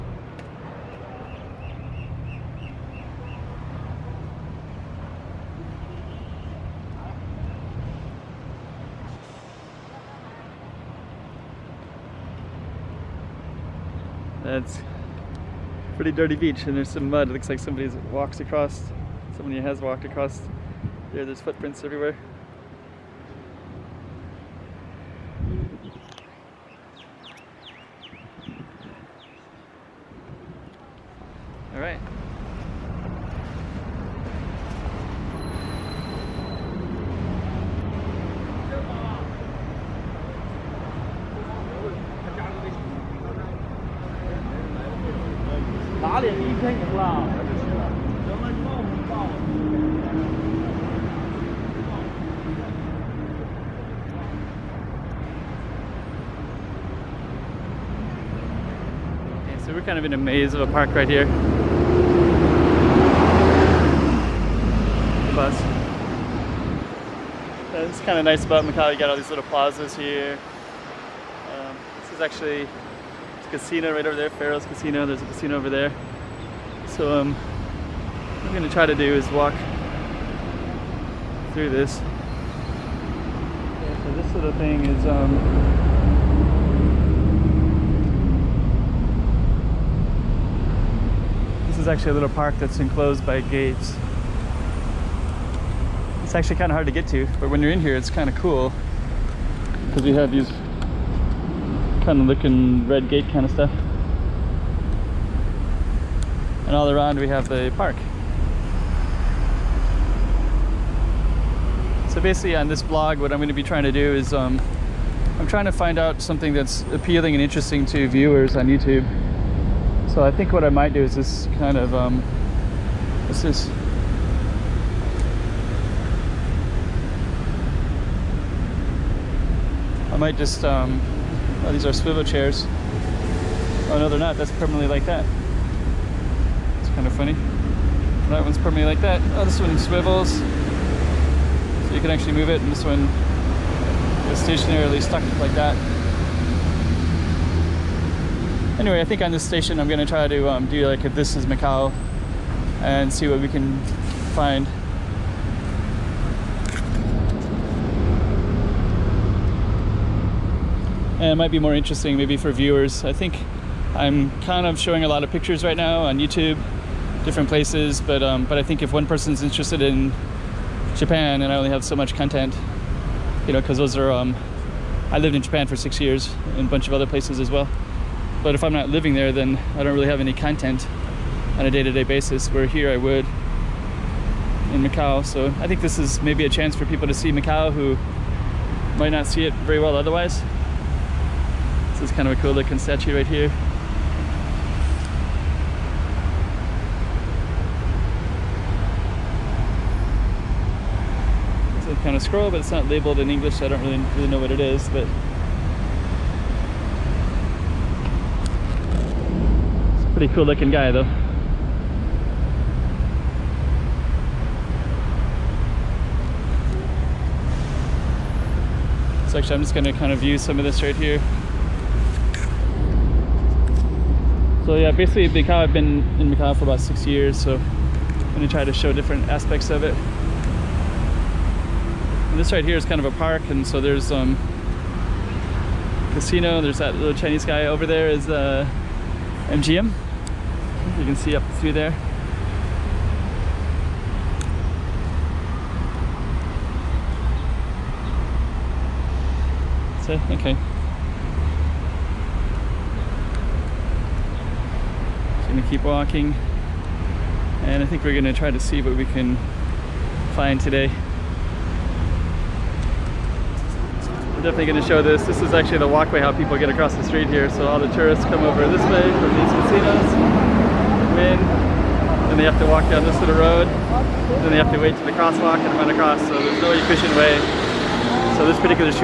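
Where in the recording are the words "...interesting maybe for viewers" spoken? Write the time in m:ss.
2:41.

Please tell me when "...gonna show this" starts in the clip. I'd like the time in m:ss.
4:24.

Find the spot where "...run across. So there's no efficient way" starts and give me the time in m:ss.
4:35.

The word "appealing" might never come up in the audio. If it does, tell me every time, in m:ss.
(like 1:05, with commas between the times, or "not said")
1:56.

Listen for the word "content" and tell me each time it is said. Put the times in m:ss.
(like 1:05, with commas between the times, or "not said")
2:52, 3:00.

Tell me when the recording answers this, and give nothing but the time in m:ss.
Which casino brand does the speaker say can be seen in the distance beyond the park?
3:59.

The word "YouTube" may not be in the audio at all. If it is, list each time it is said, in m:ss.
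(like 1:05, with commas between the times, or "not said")
1:58, 2:46.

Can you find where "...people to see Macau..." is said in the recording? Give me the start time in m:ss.
3:06.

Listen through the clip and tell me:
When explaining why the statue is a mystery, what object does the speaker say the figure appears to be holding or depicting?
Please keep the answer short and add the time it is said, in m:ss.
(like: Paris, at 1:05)
Scroll, at 3:22.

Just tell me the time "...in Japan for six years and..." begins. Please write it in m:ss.
2:55.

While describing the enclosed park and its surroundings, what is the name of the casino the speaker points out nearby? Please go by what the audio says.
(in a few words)
Pharaoh's Casino.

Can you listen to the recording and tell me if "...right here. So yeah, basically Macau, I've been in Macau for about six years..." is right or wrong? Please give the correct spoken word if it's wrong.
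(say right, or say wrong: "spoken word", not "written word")
right.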